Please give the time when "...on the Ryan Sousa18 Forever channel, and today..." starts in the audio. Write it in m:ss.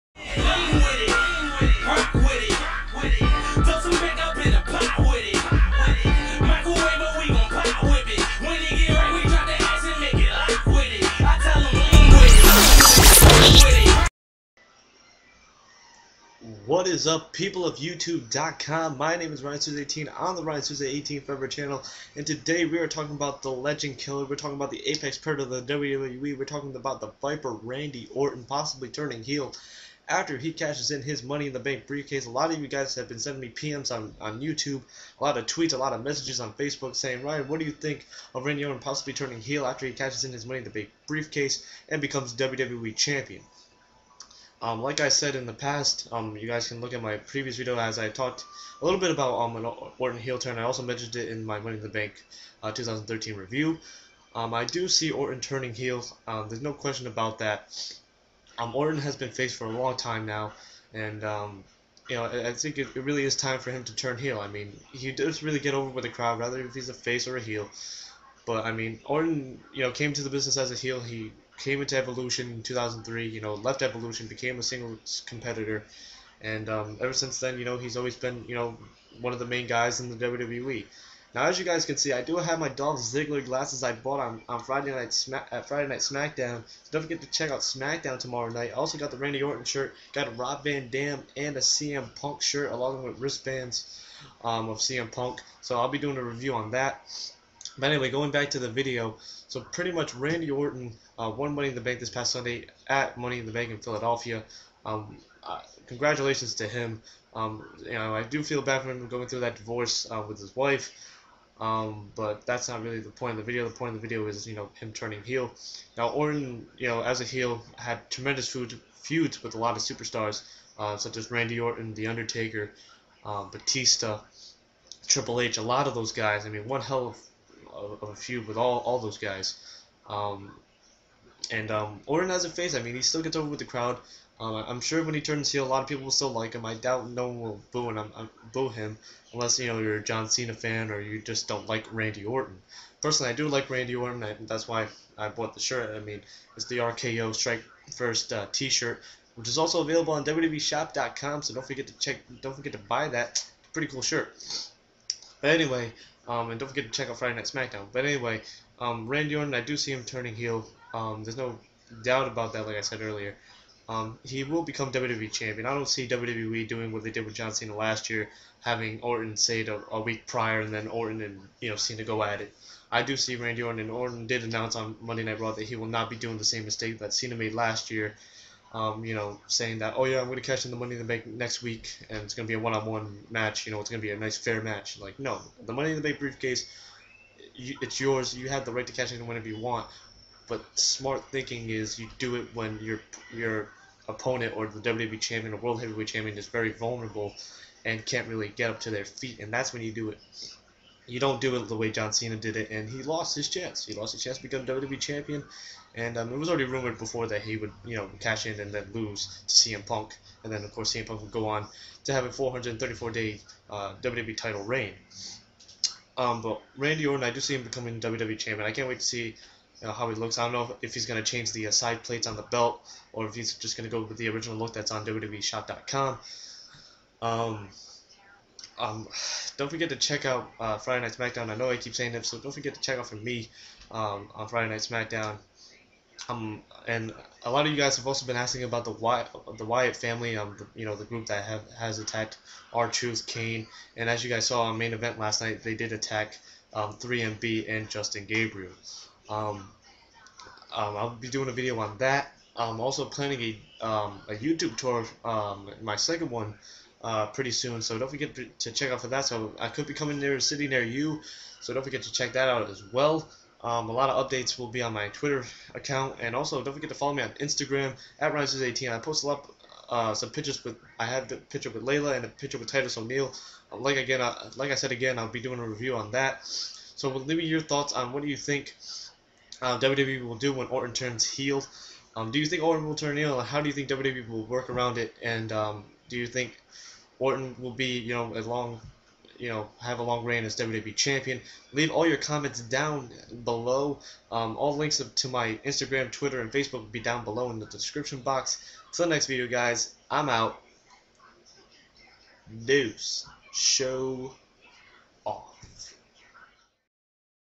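0:20.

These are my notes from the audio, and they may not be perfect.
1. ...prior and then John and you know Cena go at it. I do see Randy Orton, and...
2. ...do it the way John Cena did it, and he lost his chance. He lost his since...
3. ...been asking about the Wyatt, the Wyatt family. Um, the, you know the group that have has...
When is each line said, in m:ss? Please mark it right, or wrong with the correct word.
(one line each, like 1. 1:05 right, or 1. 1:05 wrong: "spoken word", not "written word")
1. 2:50 wrong: "Orton", not "John"
2. 3:21 wrong: "chance", not "since"
3. 3:58 right.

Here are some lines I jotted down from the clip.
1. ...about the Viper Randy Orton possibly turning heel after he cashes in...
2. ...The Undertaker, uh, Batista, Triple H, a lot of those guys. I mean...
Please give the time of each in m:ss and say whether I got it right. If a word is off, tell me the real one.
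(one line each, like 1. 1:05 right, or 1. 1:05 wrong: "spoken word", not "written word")
1. 0:26 right
2. 2:01 right.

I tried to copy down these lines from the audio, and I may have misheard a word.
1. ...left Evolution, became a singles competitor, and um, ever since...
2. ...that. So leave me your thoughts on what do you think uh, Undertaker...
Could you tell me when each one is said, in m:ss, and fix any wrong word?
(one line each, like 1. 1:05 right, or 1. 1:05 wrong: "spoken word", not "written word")
1. 1:13 right
2. 4:36 wrong: "WWE", not "Undertaker".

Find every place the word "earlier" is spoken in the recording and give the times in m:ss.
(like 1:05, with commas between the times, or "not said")
2:43.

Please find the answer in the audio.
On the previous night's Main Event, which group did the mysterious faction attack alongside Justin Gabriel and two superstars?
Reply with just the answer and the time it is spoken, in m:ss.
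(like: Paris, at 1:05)
3MB, at 4:06.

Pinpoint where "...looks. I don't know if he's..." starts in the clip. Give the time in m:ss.
3:40.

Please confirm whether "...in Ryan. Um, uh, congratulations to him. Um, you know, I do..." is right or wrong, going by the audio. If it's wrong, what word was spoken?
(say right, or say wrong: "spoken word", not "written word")
wrong: "Philadelphia", not "Ryan".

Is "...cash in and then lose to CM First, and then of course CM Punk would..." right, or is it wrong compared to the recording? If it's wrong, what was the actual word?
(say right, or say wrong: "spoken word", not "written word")
wrong: "Punk", not "First".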